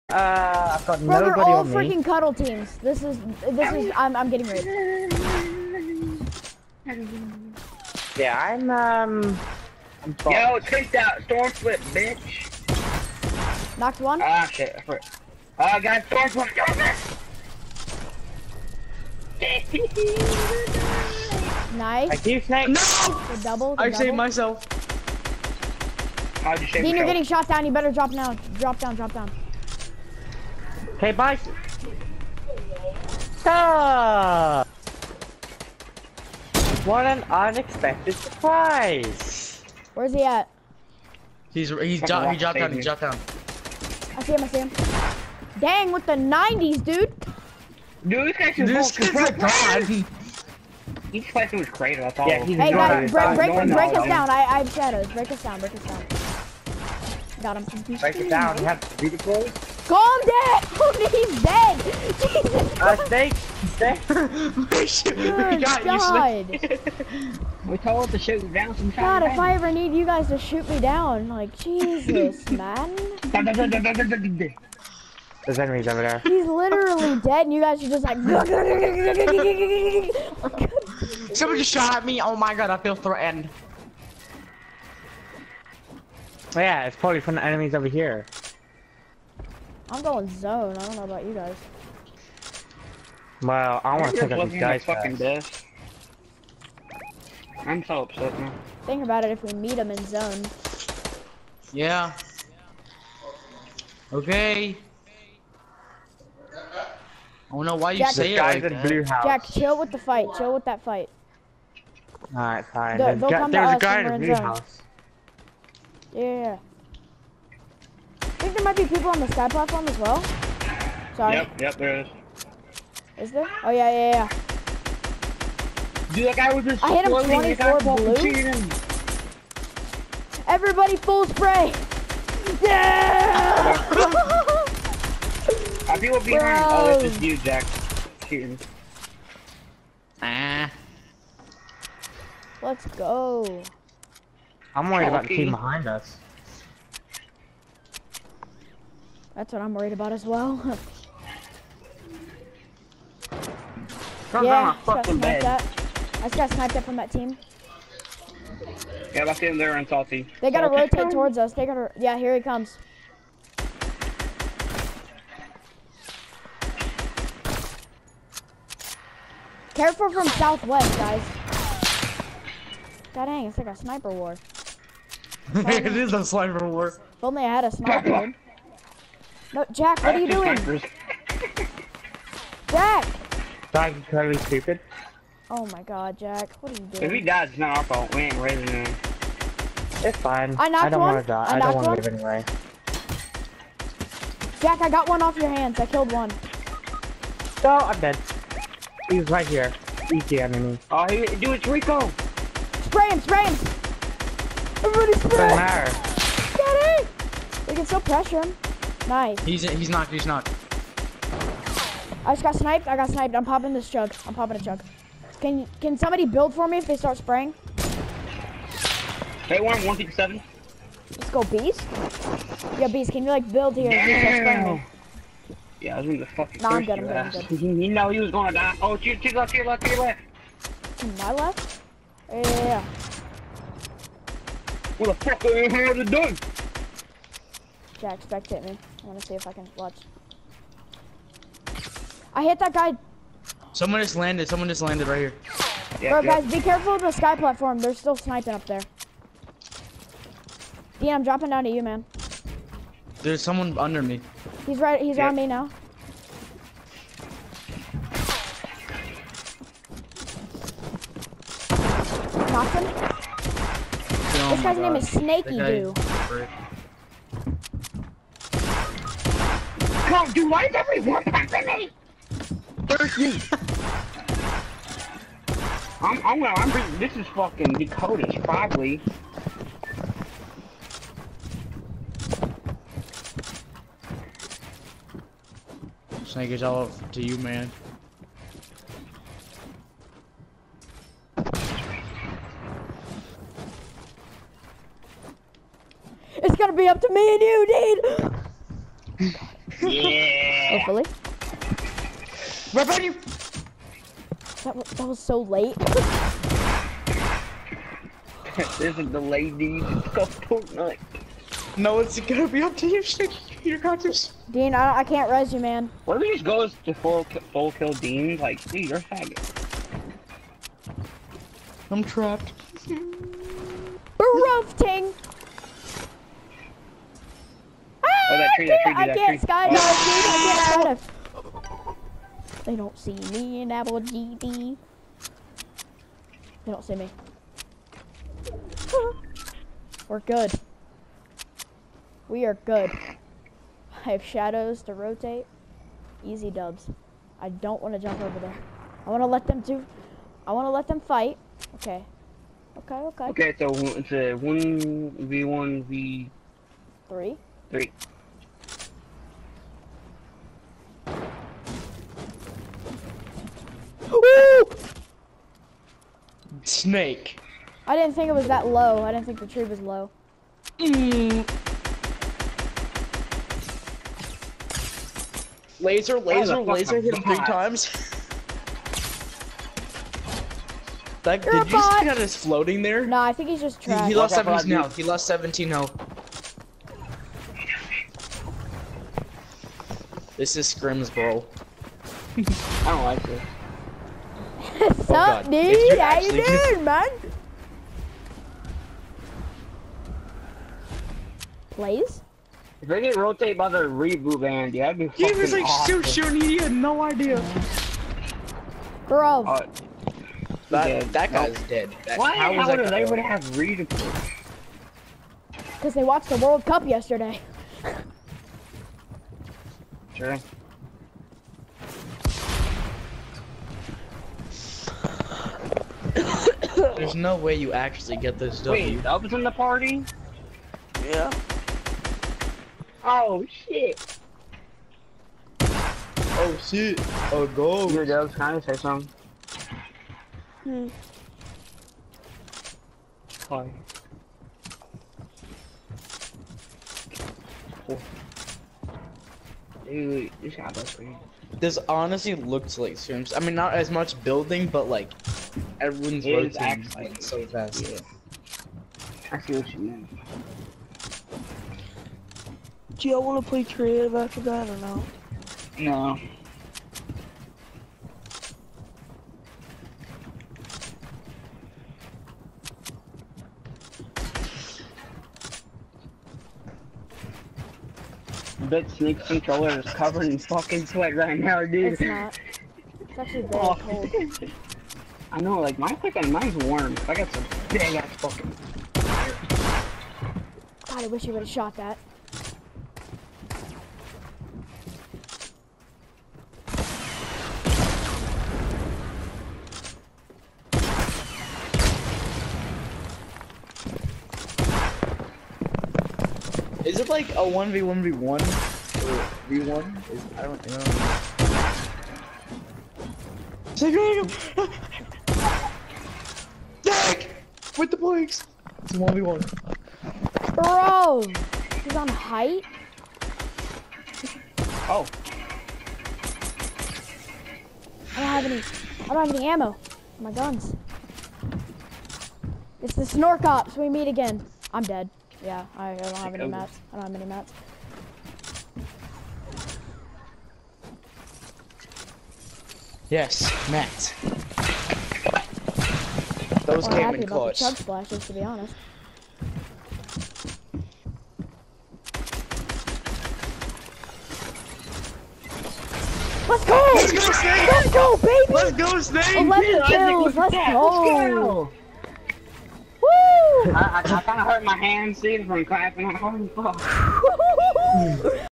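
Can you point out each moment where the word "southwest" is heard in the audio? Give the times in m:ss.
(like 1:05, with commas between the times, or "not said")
2:50.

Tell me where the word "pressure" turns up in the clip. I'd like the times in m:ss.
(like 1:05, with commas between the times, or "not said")
3:27.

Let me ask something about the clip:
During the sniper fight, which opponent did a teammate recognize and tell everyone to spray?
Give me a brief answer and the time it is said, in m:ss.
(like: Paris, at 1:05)
Rico, at 3:21.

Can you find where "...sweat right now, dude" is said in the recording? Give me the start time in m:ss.
8:00.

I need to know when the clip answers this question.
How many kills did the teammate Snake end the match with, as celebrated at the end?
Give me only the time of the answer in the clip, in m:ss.
9:19.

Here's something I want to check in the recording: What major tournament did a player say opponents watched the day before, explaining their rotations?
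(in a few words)
World Cup.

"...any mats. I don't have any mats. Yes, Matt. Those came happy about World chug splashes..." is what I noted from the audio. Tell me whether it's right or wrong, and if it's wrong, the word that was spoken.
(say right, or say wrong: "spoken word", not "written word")
wrong: "The", not "World".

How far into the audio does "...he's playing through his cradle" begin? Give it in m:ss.
0:51.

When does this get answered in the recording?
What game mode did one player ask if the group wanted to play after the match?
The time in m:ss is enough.
7:43.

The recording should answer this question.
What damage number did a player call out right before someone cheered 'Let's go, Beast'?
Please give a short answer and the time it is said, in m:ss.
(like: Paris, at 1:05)
157, at 3:39.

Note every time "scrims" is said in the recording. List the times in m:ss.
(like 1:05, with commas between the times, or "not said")
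6:30, 7:32.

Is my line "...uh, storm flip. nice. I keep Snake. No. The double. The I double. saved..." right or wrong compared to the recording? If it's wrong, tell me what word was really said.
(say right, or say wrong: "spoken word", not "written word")
right.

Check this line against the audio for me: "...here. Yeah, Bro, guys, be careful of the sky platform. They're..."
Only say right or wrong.
right.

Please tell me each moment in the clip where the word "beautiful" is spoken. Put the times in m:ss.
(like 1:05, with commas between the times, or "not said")
0:58.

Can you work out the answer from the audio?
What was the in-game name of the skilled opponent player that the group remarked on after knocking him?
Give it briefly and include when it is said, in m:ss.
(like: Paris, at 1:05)
Snaky Doo, at 4:25.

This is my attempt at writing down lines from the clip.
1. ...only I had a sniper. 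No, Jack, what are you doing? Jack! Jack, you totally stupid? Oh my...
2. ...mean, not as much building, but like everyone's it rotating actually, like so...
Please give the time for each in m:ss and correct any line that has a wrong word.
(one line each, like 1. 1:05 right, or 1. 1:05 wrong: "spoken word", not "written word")
1. 2:57 right
2. 7:33 right.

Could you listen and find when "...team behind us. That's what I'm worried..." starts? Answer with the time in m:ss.
2:25.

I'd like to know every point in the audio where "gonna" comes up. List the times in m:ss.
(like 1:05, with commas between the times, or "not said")
3:48, 4:56, 5:12.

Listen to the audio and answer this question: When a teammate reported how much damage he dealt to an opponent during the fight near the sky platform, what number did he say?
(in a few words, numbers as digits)
24.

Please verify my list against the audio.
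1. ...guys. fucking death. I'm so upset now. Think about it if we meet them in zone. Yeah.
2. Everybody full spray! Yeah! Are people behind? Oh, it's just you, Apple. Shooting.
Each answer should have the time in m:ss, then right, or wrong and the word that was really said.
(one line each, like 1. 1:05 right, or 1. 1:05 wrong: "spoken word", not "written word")
1. 1:34 right
2. 2:10 wrong: "Jack", not "Apple".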